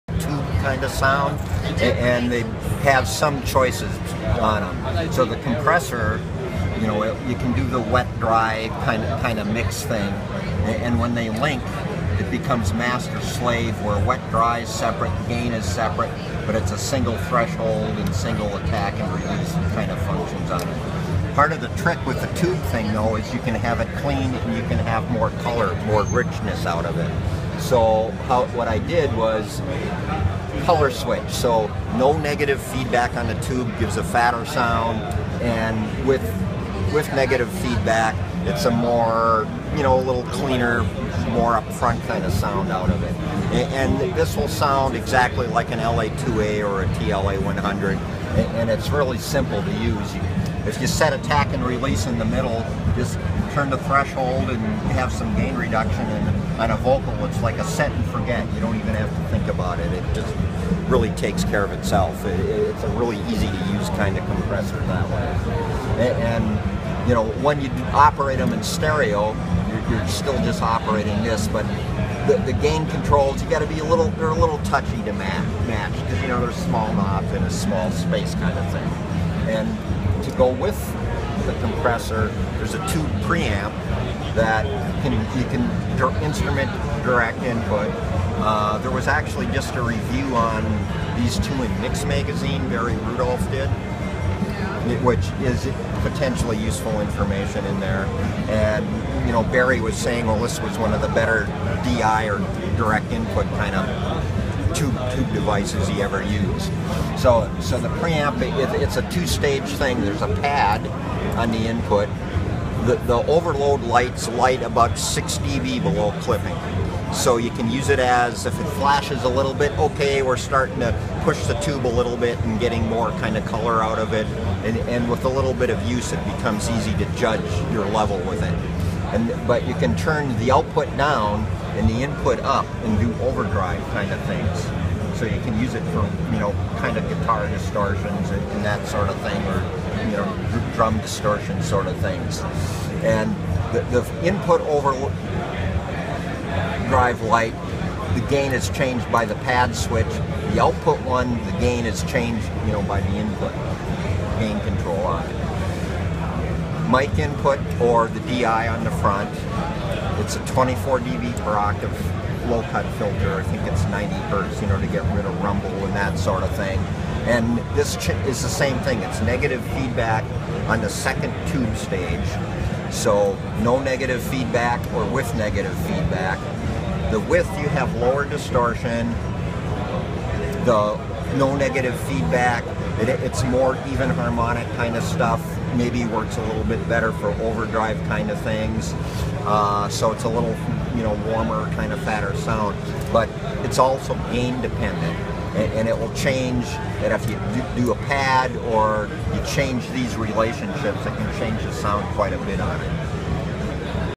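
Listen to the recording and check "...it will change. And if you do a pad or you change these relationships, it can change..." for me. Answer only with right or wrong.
right.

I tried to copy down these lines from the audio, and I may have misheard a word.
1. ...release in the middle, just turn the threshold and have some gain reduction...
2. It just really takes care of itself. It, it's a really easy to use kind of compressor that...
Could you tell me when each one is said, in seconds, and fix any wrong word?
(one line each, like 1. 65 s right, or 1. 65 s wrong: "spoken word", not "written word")
1. 51 s right
2. 59 s right.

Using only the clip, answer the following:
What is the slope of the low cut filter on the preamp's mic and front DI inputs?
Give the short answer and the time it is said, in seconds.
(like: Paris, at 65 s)
24 dB per octave, at 160 s.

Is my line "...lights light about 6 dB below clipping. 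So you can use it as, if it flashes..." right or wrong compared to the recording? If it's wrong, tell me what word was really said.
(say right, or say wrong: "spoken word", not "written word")
right.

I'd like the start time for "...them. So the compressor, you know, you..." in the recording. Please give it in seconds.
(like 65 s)
4 s.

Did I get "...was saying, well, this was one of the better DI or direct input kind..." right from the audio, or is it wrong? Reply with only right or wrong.
right.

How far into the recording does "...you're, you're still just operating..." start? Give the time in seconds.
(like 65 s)
69 s.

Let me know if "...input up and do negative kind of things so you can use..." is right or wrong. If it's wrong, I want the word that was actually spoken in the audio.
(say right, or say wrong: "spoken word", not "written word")
wrong: "overdrive", not "negative".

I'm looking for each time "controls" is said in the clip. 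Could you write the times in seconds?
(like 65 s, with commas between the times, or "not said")
72 s, 154 s.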